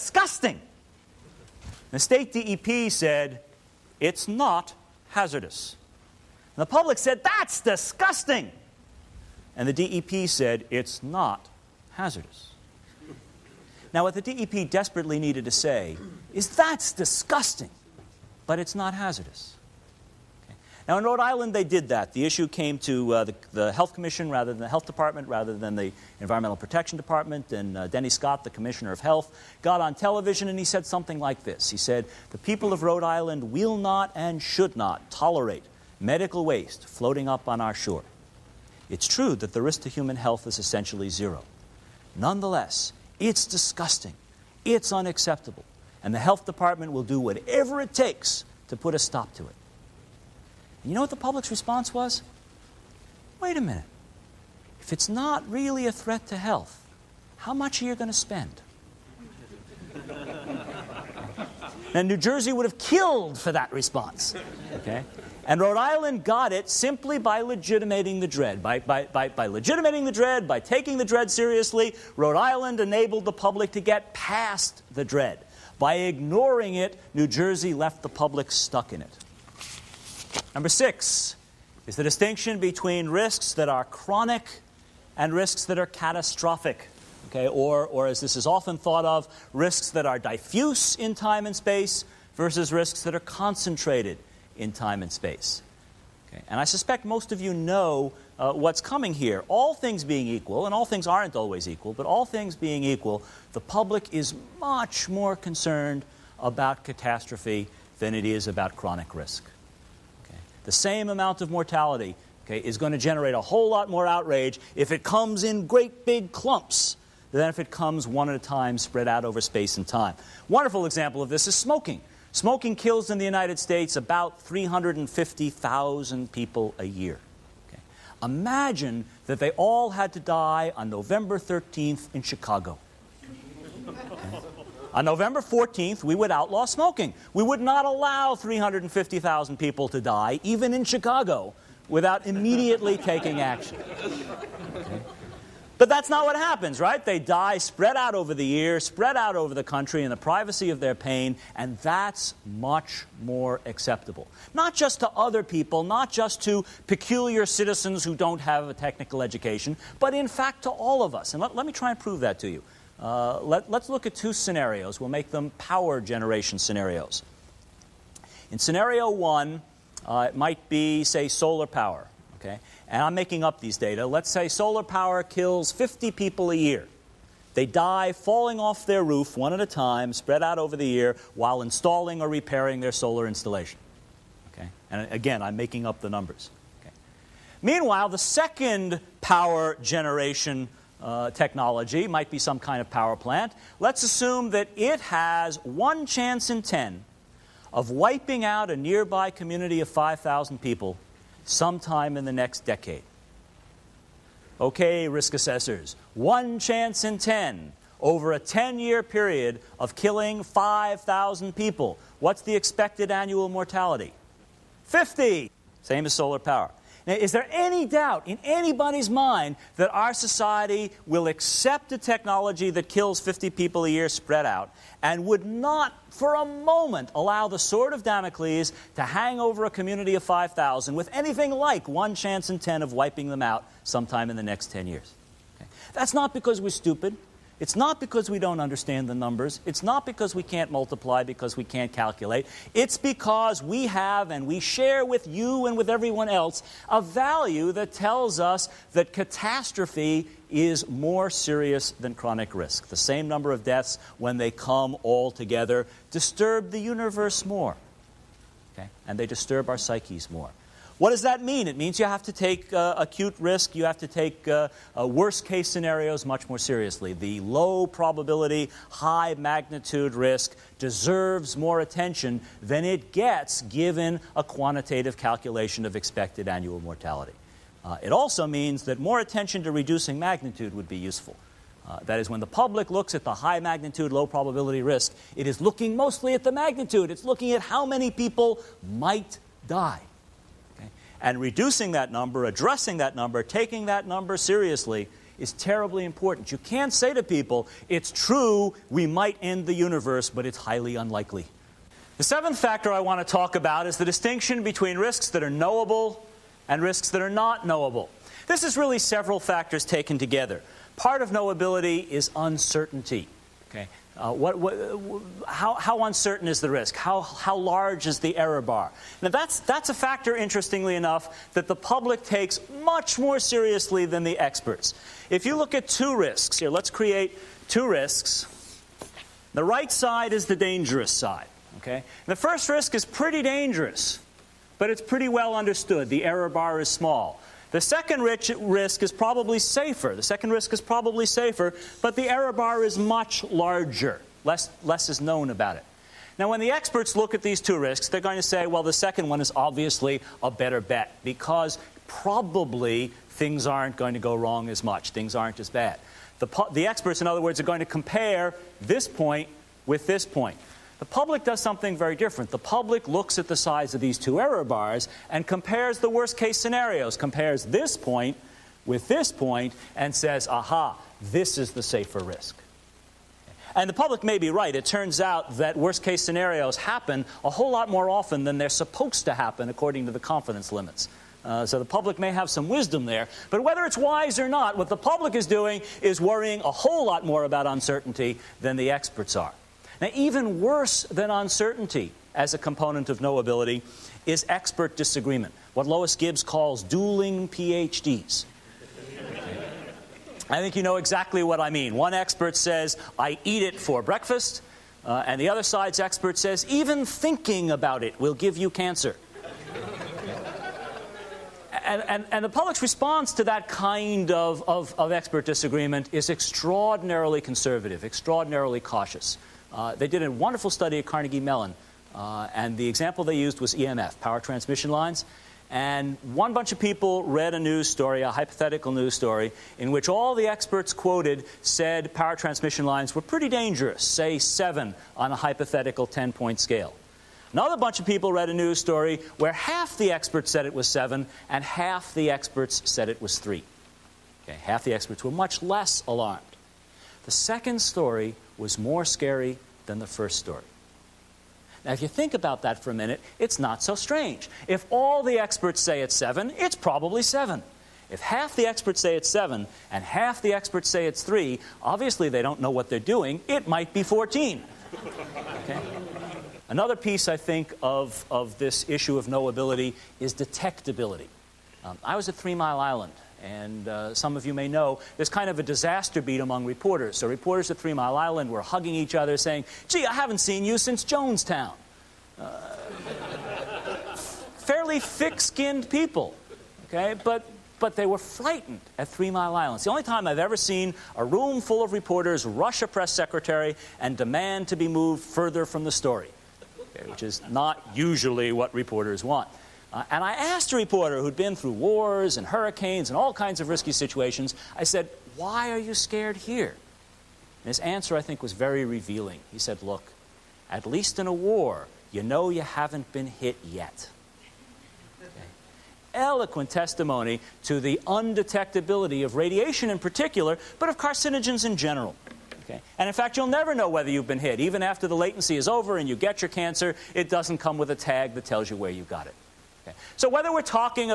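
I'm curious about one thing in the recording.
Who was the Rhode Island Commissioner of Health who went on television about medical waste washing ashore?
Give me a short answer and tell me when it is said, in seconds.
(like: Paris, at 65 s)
Denny Scott, at 27 s.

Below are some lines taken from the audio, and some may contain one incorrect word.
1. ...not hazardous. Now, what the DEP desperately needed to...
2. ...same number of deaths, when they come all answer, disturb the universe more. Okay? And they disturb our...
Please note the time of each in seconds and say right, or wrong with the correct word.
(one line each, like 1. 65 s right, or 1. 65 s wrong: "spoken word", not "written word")
1. 11 s right
2. 252 s wrong: "together", not "answer".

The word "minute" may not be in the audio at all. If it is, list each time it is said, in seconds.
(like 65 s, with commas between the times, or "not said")
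53 s, 452 s.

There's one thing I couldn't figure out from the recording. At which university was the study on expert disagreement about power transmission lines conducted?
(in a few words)
Carnegie Mellon.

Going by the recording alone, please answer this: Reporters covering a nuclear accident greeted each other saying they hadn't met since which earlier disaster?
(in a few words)
Jonestown.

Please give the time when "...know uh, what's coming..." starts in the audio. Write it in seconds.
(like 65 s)
97 s.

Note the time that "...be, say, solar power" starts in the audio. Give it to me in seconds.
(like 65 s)
170 s.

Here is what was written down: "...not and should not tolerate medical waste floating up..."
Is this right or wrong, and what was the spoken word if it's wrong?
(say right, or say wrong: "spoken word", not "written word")
right.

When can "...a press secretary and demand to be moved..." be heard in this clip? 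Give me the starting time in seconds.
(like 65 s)
492 s.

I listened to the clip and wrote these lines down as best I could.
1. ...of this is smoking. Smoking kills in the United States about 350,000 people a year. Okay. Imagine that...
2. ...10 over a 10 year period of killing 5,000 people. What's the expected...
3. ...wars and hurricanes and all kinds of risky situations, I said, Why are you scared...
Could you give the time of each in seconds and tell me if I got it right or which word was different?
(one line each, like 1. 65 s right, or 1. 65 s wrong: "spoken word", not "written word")
1. 121 s right
2. 207 s right
3. 501 s right.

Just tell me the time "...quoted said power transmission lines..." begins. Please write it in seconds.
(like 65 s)
430 s.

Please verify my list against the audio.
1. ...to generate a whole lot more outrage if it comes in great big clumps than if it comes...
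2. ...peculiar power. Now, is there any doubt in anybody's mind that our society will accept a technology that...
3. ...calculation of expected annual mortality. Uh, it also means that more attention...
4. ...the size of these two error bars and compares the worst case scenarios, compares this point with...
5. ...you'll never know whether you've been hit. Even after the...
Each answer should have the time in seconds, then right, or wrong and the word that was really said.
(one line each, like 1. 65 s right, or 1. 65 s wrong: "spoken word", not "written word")
1. 112 s right
2. 216 s wrong: "solar", not "peculiar"
3. 275 s right
4. 363 s right
5. 523 s right.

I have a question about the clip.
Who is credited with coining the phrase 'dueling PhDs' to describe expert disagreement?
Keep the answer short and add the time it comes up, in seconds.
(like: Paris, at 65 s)
Lois Gibbs, at 395 s.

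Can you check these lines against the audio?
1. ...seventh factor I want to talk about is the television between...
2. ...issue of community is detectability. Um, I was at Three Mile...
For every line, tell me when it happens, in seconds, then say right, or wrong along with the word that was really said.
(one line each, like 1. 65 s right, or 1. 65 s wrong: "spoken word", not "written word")
1. 302 s wrong: "distinction", not "television"
2. 468 s wrong: "knowability", not "community".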